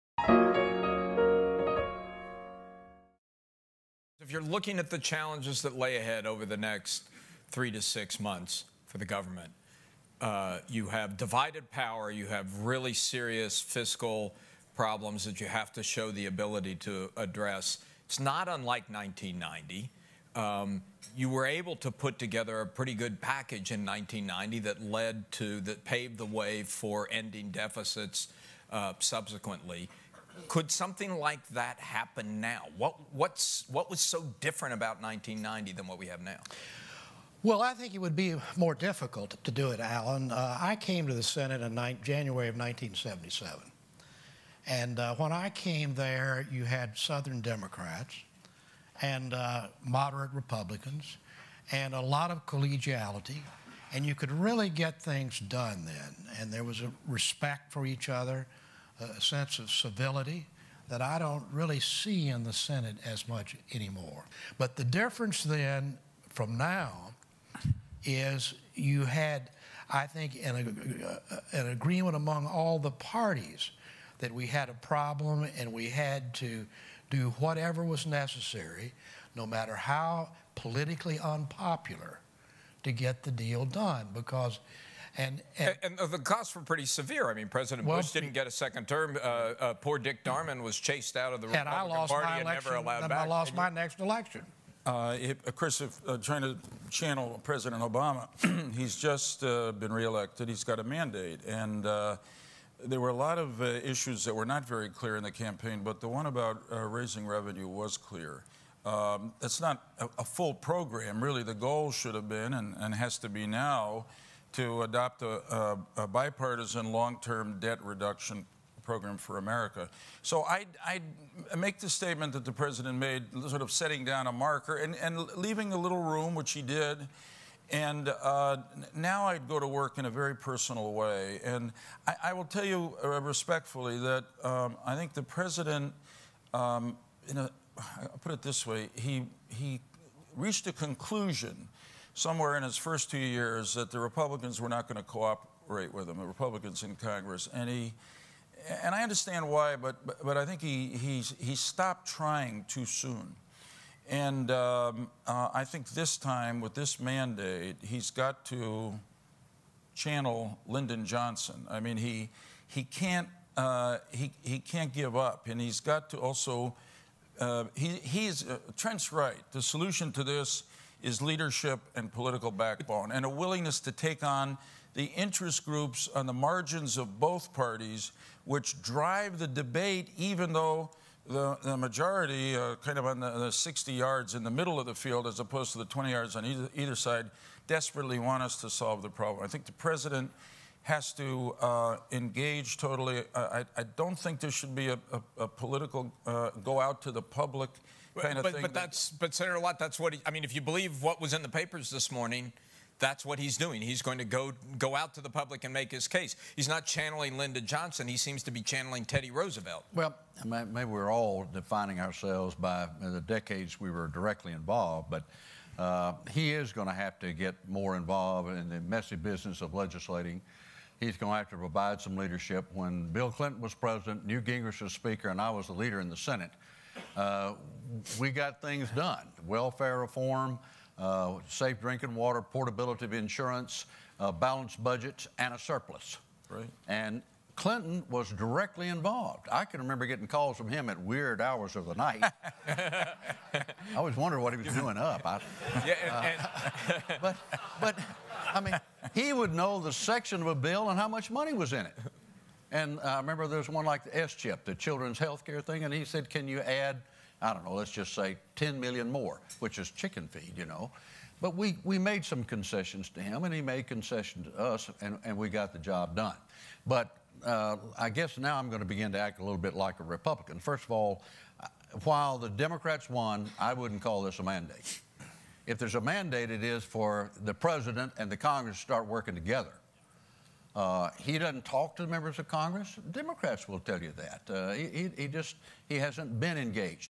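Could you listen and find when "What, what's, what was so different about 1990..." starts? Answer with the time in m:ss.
0:32.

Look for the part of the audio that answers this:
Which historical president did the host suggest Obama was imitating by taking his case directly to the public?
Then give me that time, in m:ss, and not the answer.
3:29.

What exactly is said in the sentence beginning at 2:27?
And he, and I understand why, but, but, but I think he, he, he stopped trying too soon.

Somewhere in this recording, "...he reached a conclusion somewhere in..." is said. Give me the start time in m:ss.
2:19.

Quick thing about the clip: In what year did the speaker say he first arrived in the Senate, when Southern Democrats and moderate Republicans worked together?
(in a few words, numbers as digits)
1977.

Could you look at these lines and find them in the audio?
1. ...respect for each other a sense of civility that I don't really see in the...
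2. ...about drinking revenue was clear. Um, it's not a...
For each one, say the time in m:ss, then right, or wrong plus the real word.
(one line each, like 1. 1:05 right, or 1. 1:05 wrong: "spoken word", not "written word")
1. 0:57 right
2. 1:46 wrong: "raising", not "drinking".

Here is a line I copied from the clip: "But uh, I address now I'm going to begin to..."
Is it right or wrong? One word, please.
wrong.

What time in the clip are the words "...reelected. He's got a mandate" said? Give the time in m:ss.
1:39.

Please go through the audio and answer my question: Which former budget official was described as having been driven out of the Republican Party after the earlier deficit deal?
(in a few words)
Dick Darman.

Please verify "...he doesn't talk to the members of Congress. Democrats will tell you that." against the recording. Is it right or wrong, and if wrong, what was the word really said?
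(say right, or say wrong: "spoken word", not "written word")
right.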